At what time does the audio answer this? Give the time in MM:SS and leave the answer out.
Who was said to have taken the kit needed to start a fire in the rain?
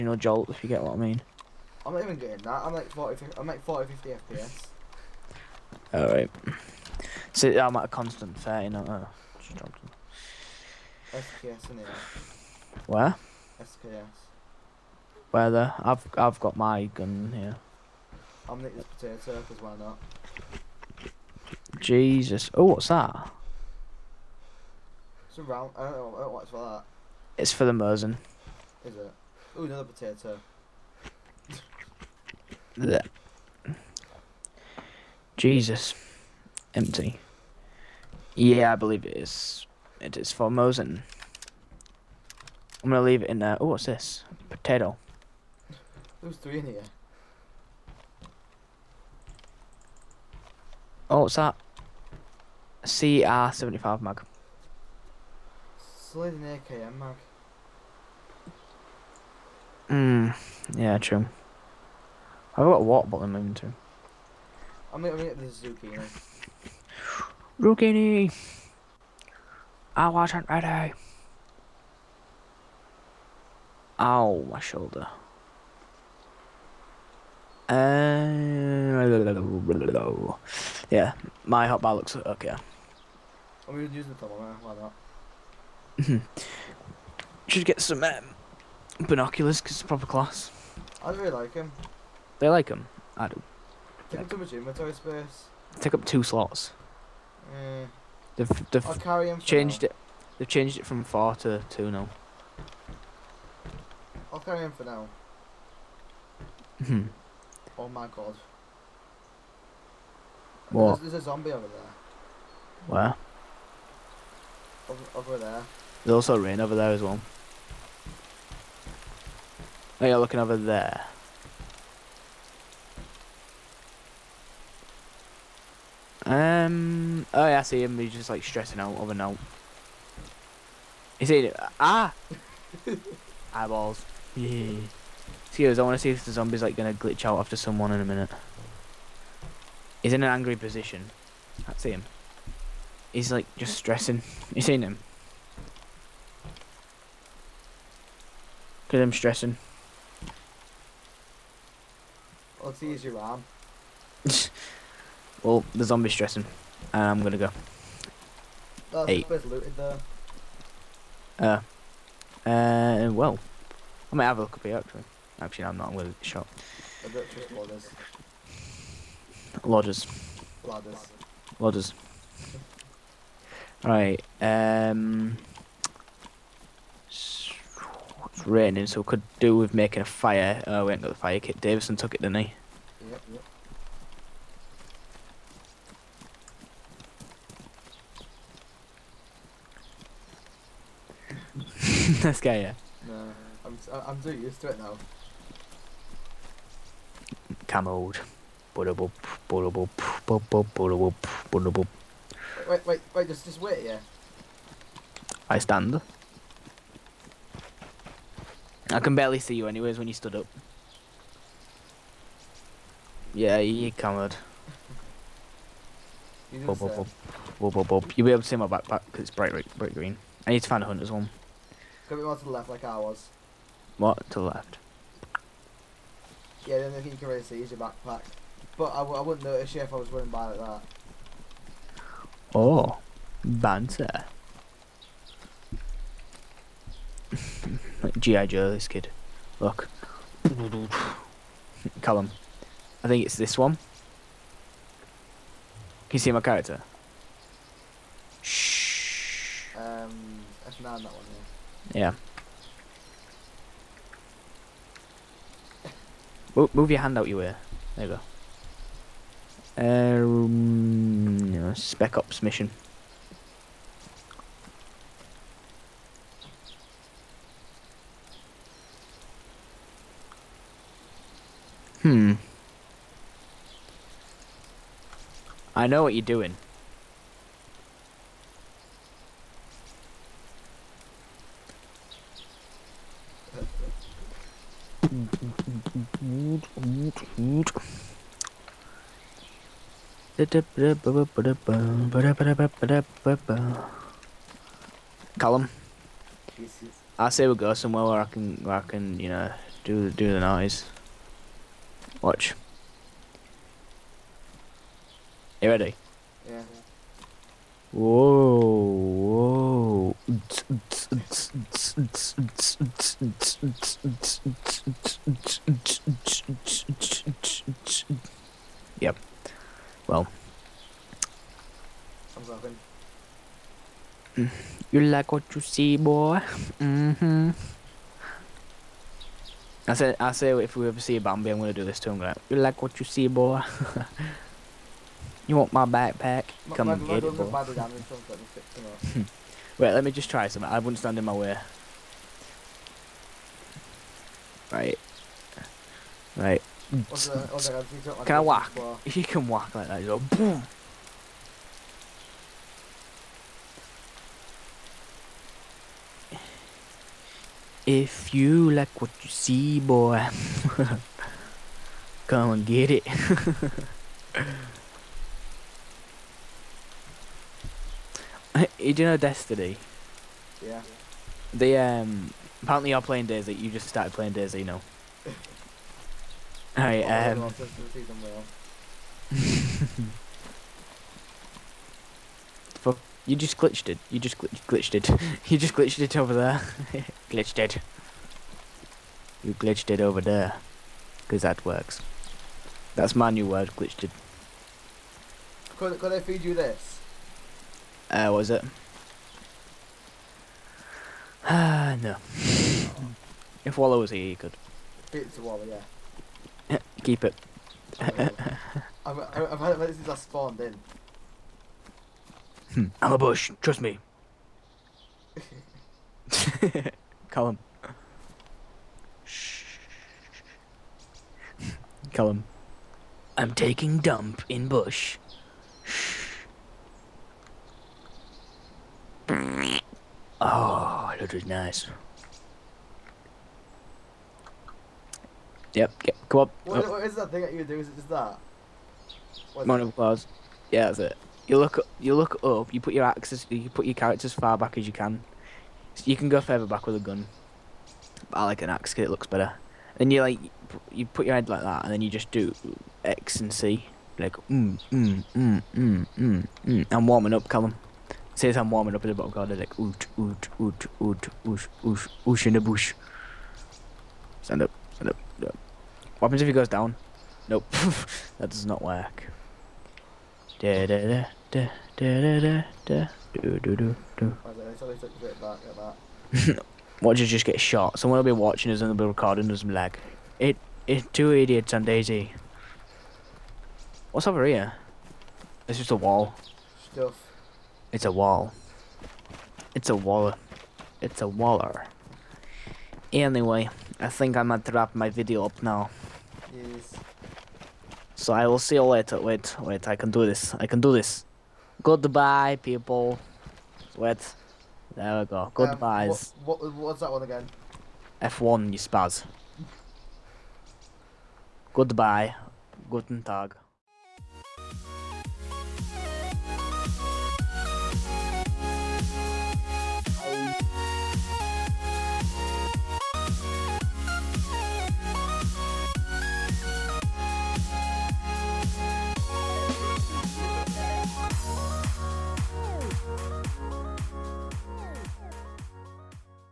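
03:01.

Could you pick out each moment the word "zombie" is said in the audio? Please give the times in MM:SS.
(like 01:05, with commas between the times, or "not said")
01:51, 02:16, 02:35.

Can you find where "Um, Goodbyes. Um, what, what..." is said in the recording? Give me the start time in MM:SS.
08:25.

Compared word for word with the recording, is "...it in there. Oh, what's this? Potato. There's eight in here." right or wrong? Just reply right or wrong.
wrong.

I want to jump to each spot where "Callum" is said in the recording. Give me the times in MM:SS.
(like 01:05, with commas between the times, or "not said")
04:02, 04:55, 06:57, 07:02, 07:37.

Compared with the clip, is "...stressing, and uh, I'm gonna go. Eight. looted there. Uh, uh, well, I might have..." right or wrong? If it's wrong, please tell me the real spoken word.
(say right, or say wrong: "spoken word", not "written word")
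right.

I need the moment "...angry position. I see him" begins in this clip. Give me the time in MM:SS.
02:20.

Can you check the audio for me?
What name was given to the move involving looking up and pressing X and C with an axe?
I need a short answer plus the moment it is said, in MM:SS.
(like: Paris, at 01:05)
Mono claws, at 07:19.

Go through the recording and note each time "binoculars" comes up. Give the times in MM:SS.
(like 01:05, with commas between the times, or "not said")
01:28.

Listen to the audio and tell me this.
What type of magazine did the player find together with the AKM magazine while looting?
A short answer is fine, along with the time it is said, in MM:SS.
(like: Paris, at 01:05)
CR75, at 00:52.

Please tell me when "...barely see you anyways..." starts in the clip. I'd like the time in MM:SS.
03:29.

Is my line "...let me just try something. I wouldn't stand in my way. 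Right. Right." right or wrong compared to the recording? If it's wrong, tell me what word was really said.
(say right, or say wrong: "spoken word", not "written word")
right.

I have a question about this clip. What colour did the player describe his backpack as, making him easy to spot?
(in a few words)
bright green.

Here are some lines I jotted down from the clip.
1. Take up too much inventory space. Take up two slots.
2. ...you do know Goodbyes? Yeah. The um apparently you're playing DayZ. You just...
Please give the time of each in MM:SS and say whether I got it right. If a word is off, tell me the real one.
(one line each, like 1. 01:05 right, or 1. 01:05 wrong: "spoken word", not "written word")
1. 01:34 right
2. 06:08 wrong: "Destiny", not "Goodbyes".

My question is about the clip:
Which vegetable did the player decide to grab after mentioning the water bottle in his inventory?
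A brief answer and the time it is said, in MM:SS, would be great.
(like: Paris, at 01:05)
zucchini, at 01:04.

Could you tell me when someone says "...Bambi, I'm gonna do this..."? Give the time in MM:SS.
05:31.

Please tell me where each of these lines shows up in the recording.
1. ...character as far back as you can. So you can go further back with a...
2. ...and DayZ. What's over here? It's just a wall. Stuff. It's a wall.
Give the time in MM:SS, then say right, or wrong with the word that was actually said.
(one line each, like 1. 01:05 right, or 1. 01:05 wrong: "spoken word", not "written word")
1. 07:23 right
2. 08:01 right.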